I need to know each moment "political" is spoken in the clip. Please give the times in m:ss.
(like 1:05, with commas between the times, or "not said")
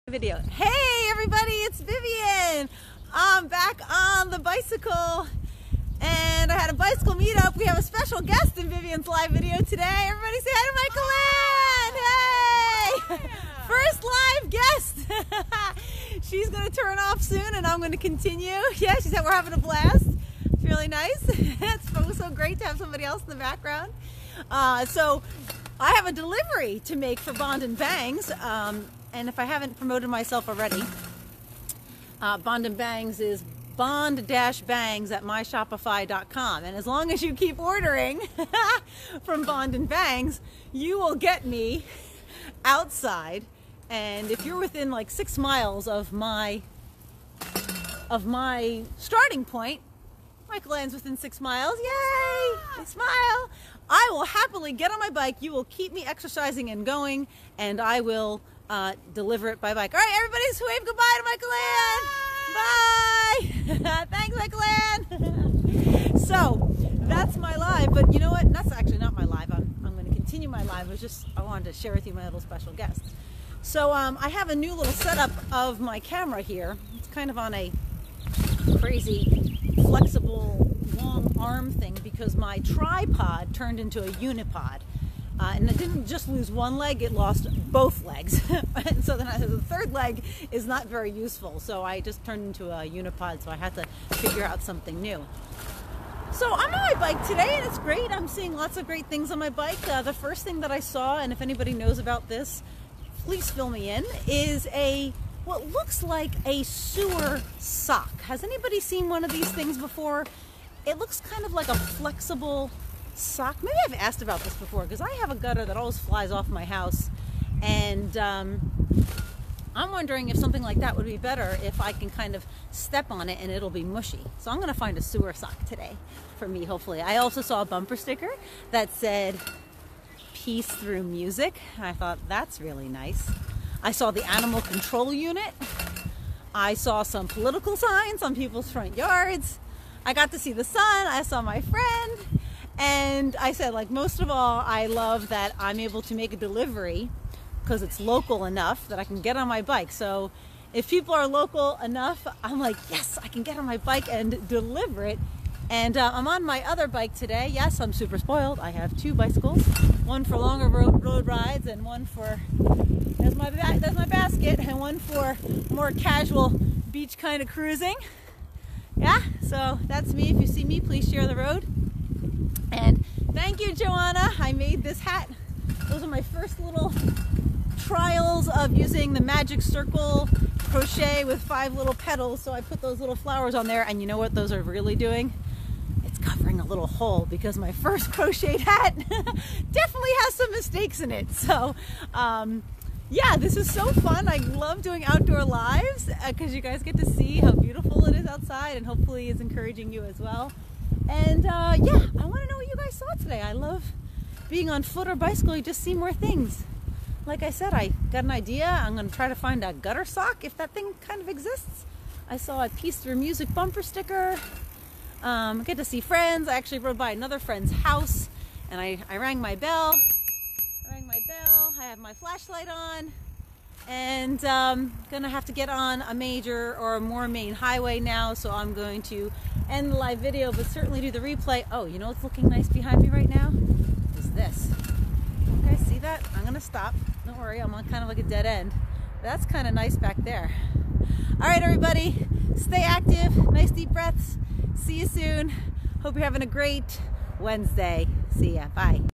2:17.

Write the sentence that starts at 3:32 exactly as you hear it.
I saw a peace through music bumper sticker.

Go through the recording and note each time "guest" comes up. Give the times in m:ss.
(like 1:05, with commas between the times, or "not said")
0:08, 0:14, 1:12.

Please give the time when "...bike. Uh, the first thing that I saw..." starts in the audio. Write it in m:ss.
1:39.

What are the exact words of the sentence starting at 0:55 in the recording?
You will keep me exercising and going, and I will uh, deliver it by bike.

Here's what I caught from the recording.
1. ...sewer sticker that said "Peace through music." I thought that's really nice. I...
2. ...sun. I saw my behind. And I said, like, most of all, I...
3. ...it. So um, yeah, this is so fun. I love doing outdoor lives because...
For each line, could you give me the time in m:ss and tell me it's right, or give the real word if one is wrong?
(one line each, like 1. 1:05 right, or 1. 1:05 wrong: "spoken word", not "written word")
1. 2:07 wrong: "bumper", not "sewer"
2. 2:20 wrong: "friend", not "behind"
3. 3:11 right.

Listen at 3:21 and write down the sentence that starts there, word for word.
And uh, yeah, I want to know what you guys today.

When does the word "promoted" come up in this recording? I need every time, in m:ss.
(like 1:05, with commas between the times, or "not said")
0:29.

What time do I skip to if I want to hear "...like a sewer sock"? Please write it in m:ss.
1:46.